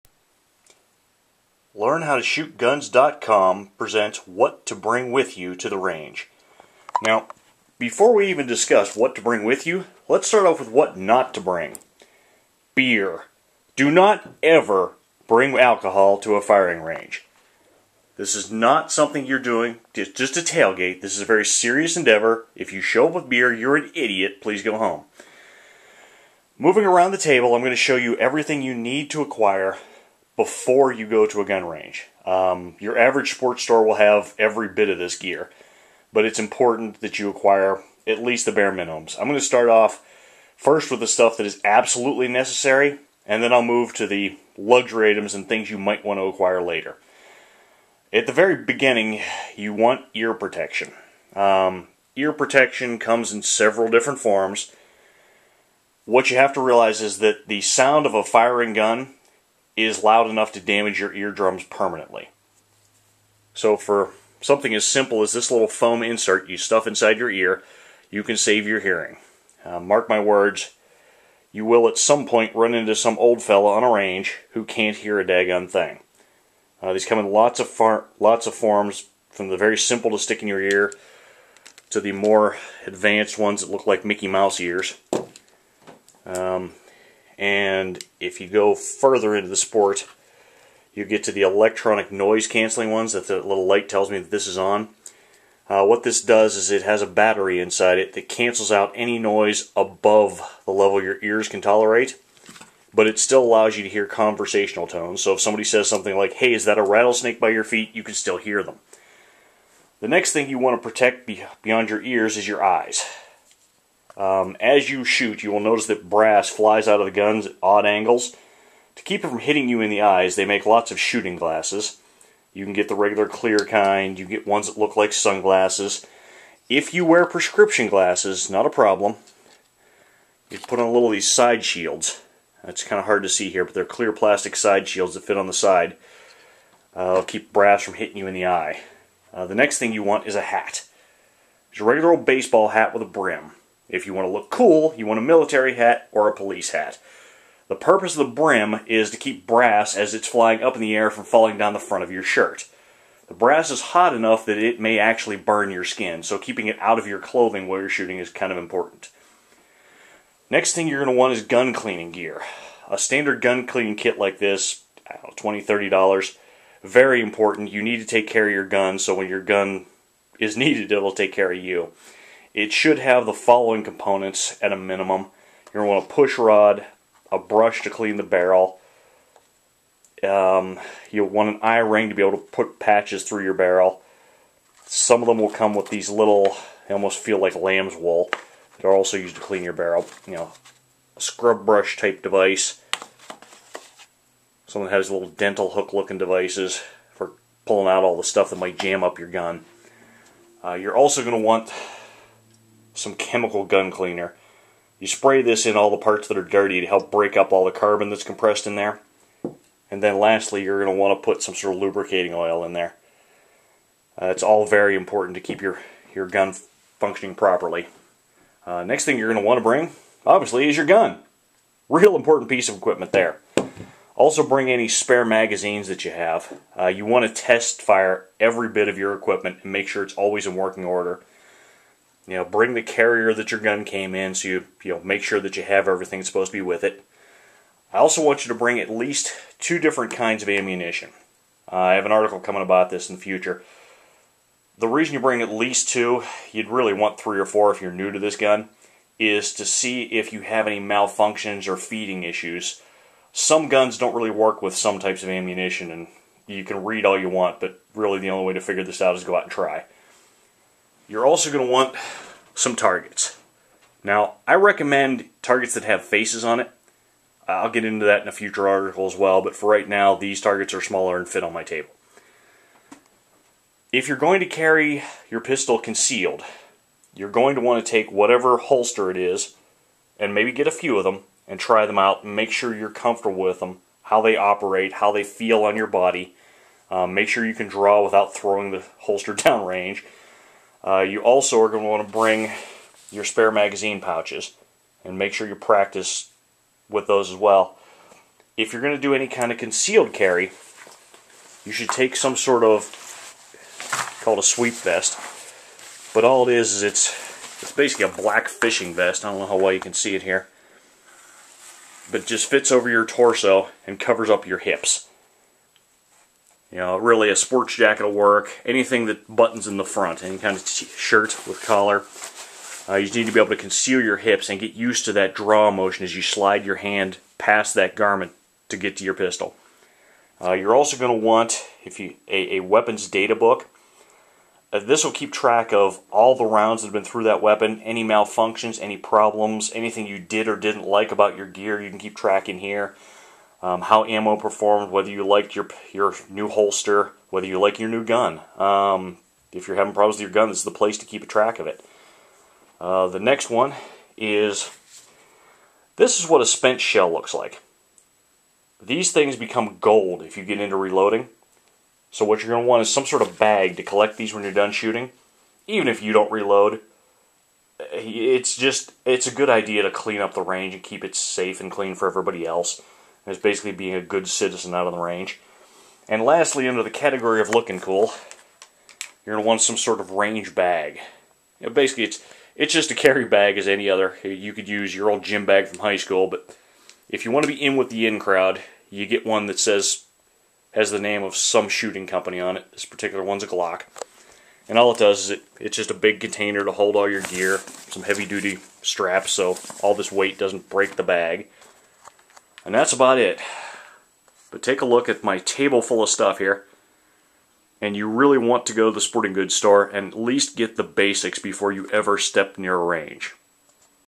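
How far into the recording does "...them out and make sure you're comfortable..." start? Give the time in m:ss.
4:41.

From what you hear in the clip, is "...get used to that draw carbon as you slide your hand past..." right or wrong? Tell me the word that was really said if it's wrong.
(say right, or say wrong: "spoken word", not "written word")
wrong: "motion", not "carbon".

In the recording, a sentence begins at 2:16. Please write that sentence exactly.
Uh, keep brass from hitting you in the eye.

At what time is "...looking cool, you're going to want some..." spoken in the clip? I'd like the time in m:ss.
6:17.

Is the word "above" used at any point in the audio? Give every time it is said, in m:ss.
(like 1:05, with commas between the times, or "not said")
1:39.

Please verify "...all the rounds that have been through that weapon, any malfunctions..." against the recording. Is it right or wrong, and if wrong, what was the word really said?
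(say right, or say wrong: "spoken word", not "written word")
right.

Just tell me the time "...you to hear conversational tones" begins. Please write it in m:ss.
1:43.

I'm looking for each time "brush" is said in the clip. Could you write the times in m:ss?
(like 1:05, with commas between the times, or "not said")
2:57, 3:11.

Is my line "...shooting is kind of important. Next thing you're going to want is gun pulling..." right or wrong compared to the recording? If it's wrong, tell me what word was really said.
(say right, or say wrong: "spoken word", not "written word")
wrong: "cleaning", not "pulling".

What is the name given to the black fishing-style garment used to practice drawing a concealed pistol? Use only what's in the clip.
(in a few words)
Sweep vest.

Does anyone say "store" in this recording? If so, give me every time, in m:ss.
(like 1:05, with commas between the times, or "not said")
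0:33, 6:49.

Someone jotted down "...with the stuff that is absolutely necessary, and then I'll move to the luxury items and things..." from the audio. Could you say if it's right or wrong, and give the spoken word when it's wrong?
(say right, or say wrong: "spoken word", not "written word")
right.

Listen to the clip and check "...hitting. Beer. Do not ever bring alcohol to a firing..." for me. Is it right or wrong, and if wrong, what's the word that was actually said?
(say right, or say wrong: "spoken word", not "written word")
wrong: "bring", not "hitting".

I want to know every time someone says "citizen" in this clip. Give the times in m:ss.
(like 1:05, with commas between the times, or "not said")
6:14.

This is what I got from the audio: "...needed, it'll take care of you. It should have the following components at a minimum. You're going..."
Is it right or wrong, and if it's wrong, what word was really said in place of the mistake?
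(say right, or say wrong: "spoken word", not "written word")
right.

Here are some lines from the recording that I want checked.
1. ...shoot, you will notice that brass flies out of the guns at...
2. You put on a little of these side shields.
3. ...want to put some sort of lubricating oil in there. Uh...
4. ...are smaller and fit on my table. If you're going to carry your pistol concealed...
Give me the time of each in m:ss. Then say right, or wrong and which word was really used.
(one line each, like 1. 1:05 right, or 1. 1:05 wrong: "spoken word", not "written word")
1. 1:55 right
2. 2:10 right
3. 3:30 right
4. 4:30 right.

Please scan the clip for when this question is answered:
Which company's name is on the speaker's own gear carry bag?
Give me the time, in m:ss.
6:33.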